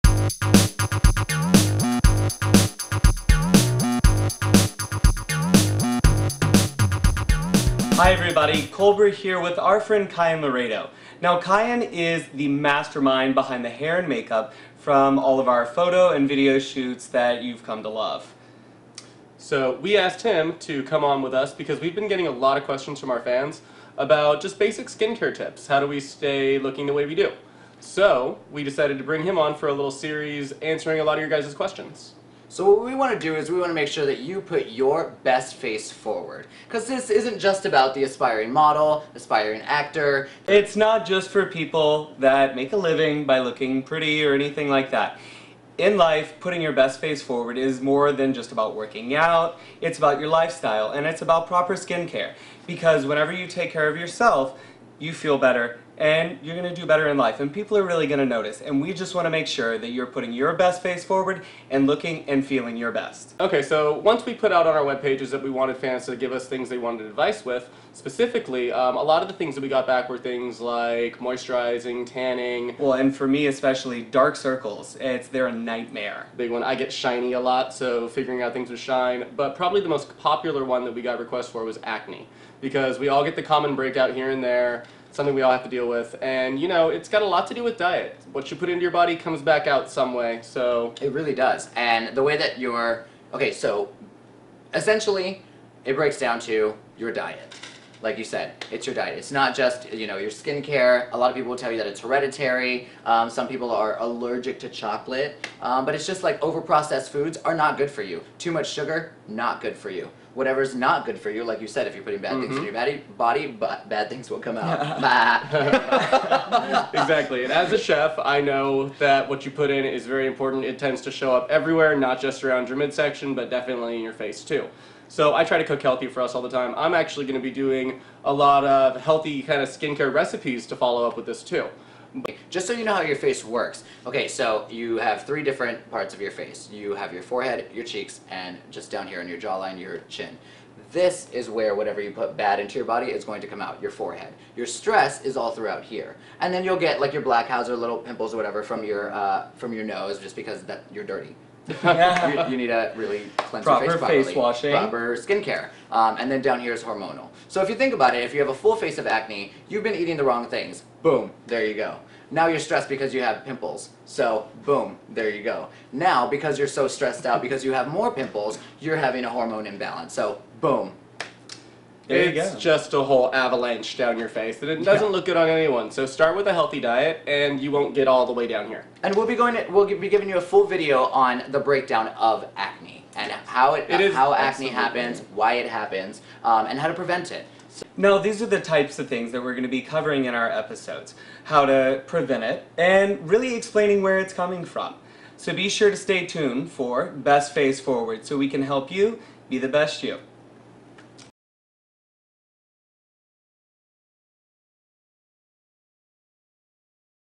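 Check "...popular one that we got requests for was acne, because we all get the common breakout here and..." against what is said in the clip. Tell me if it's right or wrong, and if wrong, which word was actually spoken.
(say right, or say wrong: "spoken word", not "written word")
right.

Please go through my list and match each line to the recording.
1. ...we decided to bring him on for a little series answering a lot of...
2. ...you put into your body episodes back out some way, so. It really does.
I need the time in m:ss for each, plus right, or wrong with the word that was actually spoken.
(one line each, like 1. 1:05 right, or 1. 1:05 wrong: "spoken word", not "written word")
1. 0:28 right
2. 1:28 wrong: "comes", not "episodes".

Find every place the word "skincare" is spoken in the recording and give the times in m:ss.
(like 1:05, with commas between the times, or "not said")
0:24, 0:51, 1:40, 2:09, 2:35.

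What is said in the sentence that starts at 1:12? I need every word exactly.
Well, and for me especially, dark circles.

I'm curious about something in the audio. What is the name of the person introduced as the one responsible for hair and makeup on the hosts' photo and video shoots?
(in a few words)
Kyan Laredo.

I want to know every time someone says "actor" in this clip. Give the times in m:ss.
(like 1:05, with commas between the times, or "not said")
0:39.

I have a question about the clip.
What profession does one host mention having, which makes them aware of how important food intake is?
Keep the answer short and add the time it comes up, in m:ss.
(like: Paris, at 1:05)
chef, at 1:57.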